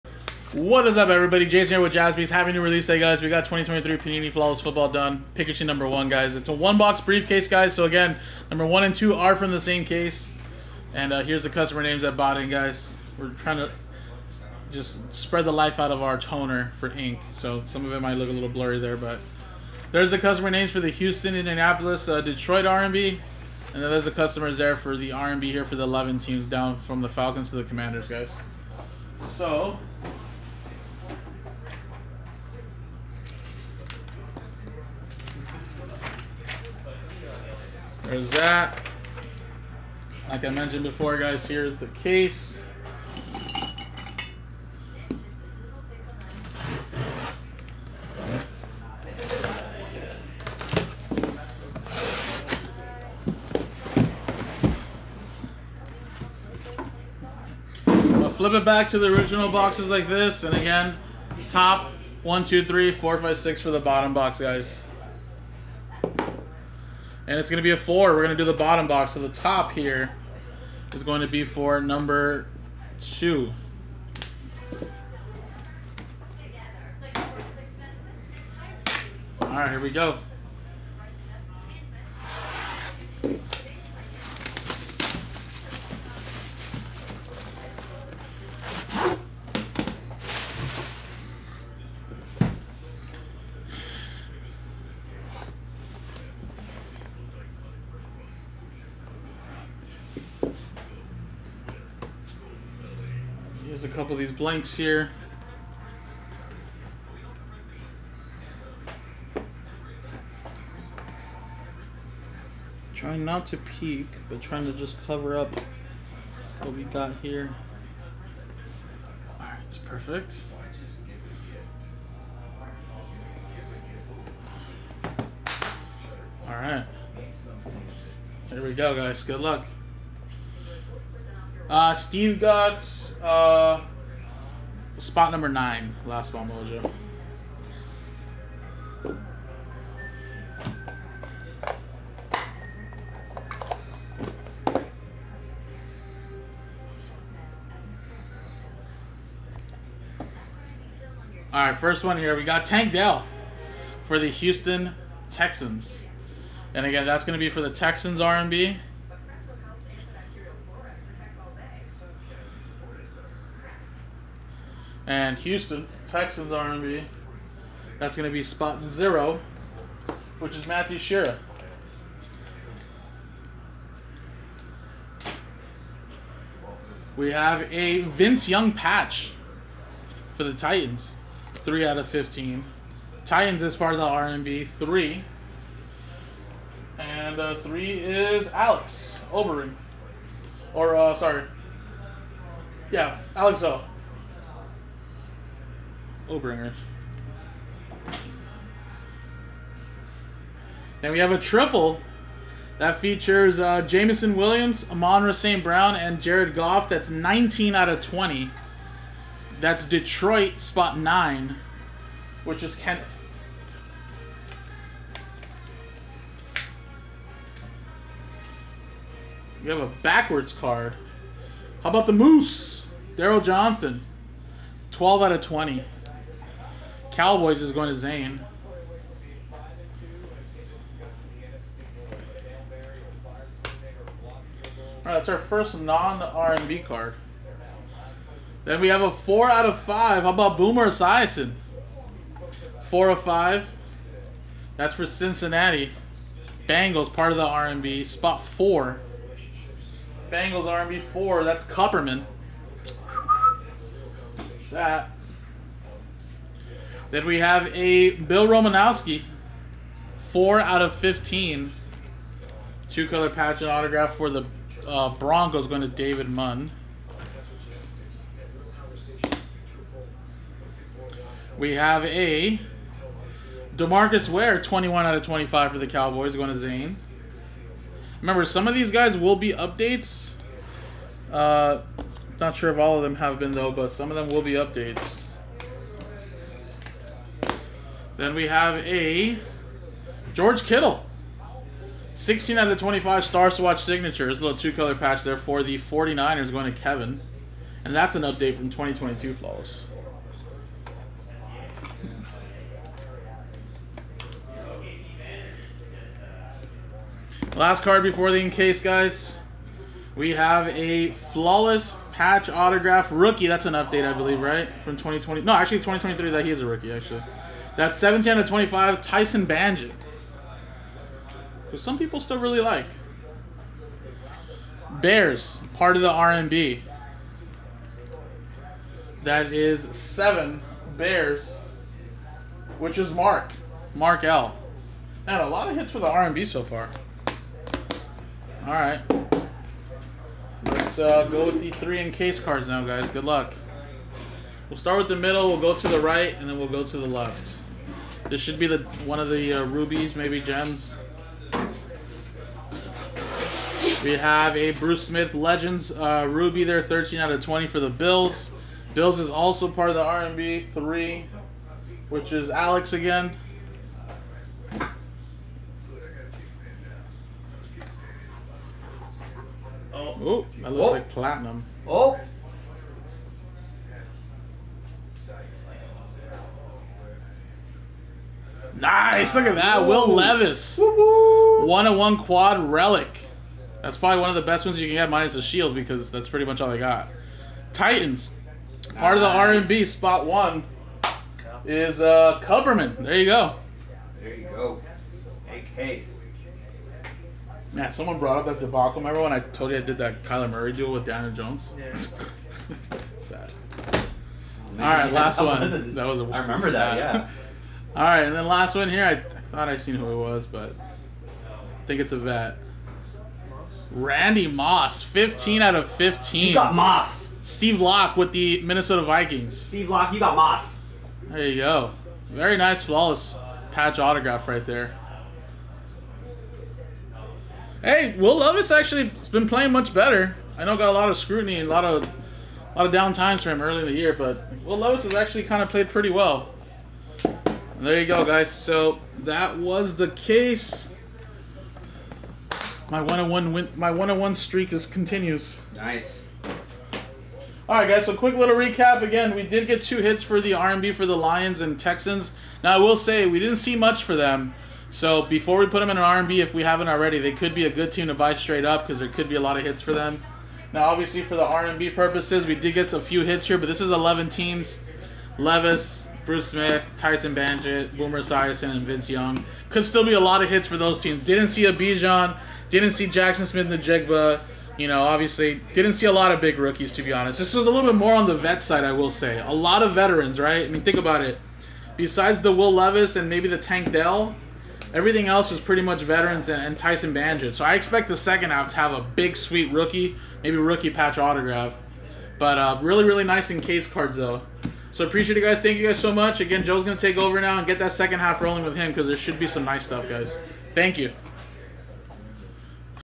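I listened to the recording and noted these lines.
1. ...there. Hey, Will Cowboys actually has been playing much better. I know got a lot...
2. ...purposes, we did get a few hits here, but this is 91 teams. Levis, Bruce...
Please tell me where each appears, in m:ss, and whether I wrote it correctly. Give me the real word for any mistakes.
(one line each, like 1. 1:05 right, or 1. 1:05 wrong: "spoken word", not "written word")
1. 7:04 wrong: "Levis", not "Cowboys"
2. 7:41 wrong: "11", not "91".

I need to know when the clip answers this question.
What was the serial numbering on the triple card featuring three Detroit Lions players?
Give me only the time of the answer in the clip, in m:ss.
3:27.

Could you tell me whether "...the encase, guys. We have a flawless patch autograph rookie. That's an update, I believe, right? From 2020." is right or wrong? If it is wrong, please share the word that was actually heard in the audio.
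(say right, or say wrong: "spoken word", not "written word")
right.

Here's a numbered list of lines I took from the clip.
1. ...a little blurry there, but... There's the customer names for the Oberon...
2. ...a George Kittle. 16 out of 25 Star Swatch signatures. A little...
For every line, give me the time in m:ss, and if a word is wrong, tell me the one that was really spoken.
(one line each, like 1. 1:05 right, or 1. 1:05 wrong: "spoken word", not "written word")
1. 0:18 wrong: "Houston", not "Oberon"
2. 4:48 right.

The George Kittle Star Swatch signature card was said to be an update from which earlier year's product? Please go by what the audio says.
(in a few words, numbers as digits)
2022.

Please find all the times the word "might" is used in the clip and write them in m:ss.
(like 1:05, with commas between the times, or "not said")
0:18.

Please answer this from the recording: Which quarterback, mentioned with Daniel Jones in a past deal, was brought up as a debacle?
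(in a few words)
Kyler Murray.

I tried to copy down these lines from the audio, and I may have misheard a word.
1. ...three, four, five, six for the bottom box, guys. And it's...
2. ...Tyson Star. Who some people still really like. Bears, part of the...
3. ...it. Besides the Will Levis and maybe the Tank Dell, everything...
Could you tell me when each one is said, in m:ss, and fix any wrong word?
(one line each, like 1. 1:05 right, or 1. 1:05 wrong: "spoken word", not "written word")
1. 1:02 right
2. 5:19 wrong: "Bagent", not "Star"
3. 8:01 right.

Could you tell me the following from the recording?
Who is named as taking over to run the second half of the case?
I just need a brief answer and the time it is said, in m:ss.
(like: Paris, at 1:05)
Joe, at 8:16.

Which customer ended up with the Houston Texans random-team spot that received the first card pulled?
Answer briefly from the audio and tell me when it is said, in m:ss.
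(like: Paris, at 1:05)
Matthew Shearer, at 2:50.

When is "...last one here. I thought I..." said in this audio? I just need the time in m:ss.
6:48.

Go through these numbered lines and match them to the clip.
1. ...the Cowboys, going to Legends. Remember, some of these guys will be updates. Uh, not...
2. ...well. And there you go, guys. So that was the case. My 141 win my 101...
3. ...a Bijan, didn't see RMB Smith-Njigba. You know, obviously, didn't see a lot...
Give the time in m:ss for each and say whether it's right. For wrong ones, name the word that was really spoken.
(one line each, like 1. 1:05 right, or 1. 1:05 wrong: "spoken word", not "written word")
1. 4:35 wrong: "Zane", not "Legends"
2. 7:16 wrong: "101", not "141"
3. 7:51 wrong: "Jaxon", not "RMB".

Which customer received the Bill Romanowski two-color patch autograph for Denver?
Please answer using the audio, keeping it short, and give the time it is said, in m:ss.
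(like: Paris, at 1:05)
David Munn, at 4:25.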